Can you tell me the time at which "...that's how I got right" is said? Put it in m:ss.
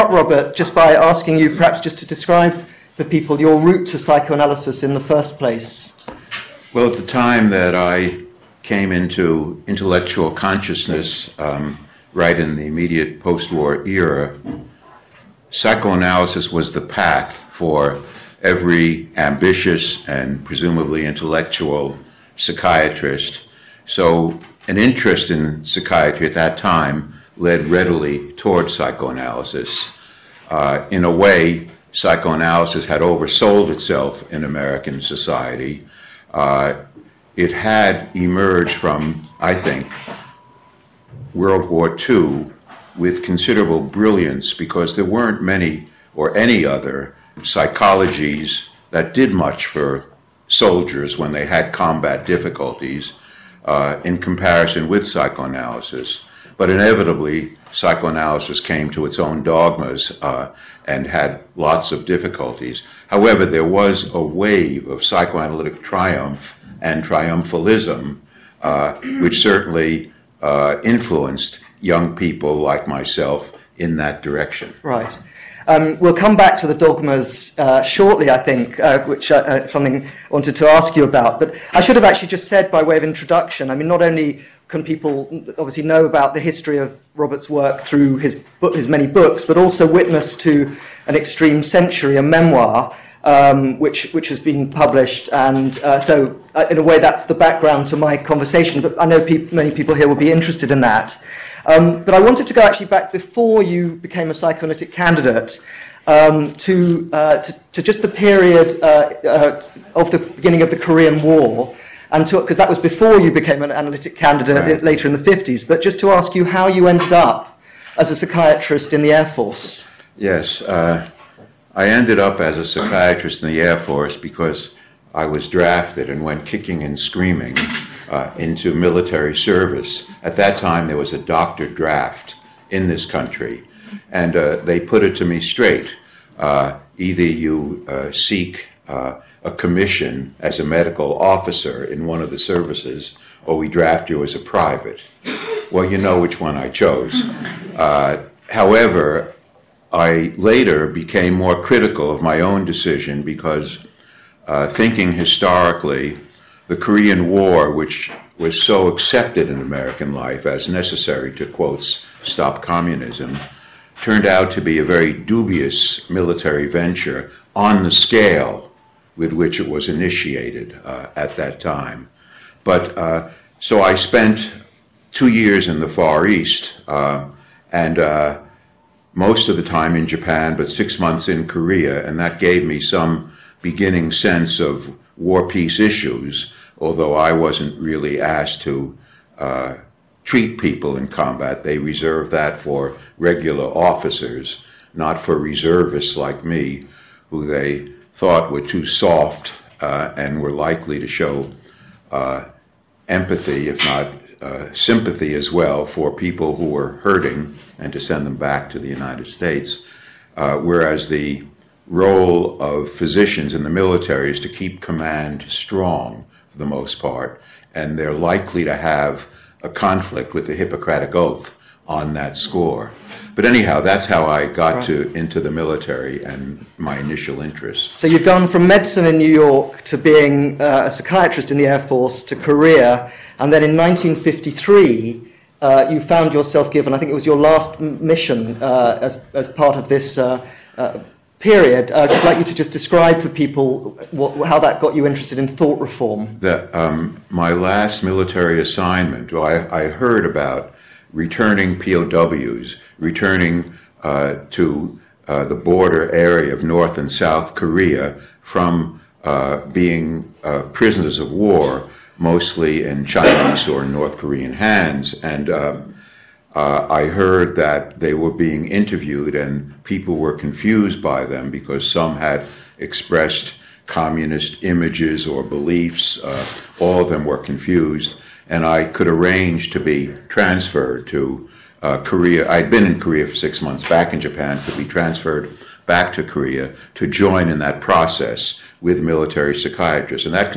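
3:43.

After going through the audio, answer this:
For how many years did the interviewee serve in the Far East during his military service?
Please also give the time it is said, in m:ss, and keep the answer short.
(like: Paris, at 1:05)
2, at 2:55.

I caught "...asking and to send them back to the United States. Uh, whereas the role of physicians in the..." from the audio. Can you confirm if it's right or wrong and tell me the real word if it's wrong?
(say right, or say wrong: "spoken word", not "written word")
wrong: "hurting", not "asking".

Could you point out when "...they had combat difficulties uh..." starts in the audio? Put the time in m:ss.
0:51.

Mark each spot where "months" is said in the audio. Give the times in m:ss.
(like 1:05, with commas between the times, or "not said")
3:00, 4:43.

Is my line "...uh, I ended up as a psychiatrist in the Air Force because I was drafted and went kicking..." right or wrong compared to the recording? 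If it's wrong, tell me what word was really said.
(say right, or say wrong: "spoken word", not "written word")
right.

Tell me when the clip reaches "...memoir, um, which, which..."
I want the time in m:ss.
1:32.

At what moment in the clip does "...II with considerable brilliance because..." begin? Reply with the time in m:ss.
0:42.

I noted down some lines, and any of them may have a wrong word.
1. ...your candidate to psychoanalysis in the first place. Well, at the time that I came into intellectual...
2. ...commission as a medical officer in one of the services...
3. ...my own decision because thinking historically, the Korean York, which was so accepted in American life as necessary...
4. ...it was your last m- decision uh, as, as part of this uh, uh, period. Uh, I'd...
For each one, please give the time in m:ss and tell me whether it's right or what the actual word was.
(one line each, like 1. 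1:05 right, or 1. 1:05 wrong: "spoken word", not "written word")
1. 0:03 wrong: "route", not "candidate"
2. 2:19 right
3. 2:32 wrong: "War", not "York"
4. 3:57 wrong: "mission", not "decision".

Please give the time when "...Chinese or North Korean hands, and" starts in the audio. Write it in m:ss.
4:23.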